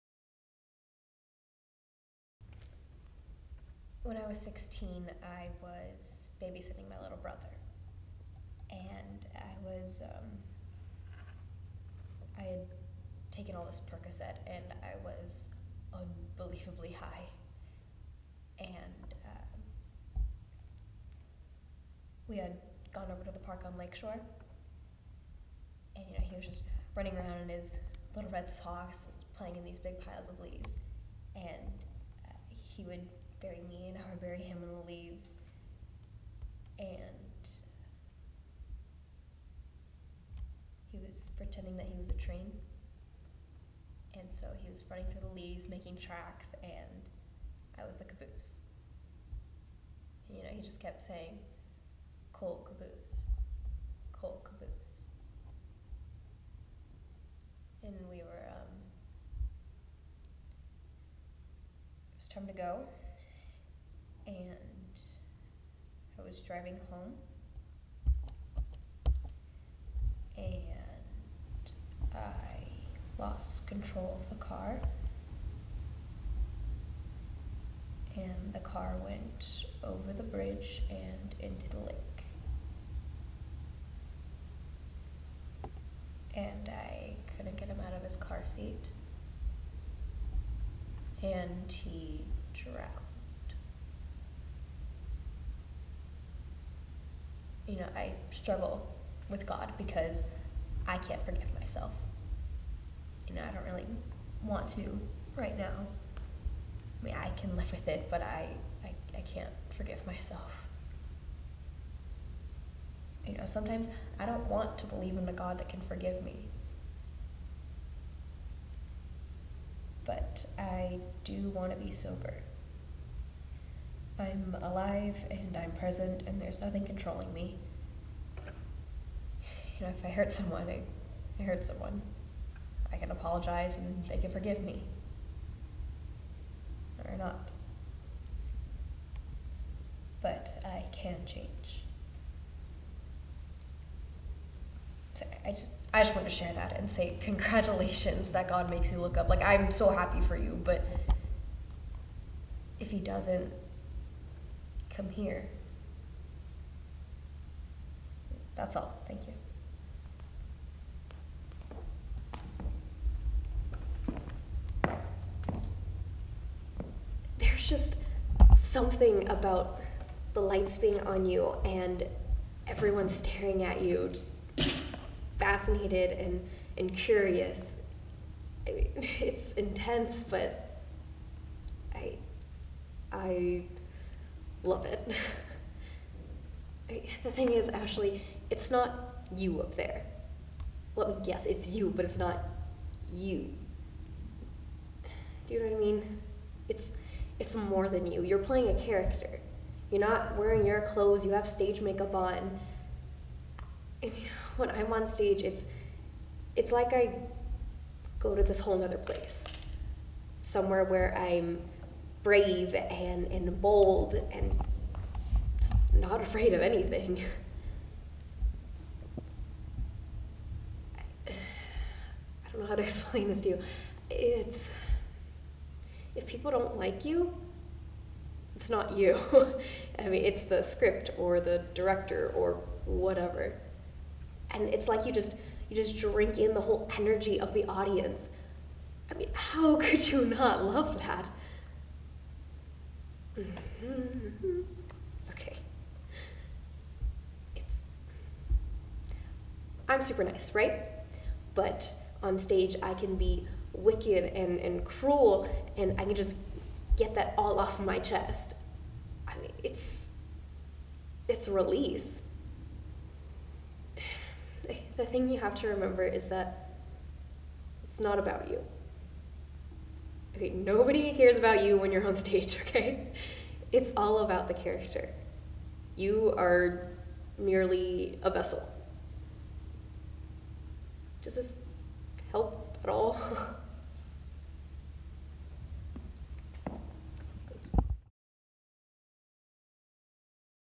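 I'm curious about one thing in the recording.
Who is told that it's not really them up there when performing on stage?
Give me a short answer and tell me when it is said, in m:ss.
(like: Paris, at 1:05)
Ashley, at 3:07.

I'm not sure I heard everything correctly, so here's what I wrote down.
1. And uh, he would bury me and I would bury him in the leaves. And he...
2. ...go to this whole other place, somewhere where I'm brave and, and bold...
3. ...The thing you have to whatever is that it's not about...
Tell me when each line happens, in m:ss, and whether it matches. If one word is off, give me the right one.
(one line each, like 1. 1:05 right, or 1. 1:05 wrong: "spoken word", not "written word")
1. 0:31 right
2. 3:28 right
3. 4:24 wrong: "remember", not "whatever".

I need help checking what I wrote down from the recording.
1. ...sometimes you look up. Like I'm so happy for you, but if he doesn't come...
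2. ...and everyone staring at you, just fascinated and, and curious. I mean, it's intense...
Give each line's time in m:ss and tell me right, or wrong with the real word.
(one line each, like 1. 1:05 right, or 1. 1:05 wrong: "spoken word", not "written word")
1. 2:28 wrong: "makes", not "sometimes"
2. 2:51 right.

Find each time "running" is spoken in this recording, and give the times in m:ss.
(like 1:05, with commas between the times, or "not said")
0:26, 0:44.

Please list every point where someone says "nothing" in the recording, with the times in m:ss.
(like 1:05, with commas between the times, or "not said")
2:06.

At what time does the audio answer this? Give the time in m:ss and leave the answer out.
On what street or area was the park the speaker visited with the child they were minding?
0:23.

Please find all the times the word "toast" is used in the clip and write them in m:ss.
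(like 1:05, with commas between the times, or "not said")
not said.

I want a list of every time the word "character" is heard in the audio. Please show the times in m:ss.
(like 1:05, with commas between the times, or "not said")
3:18, 4:34.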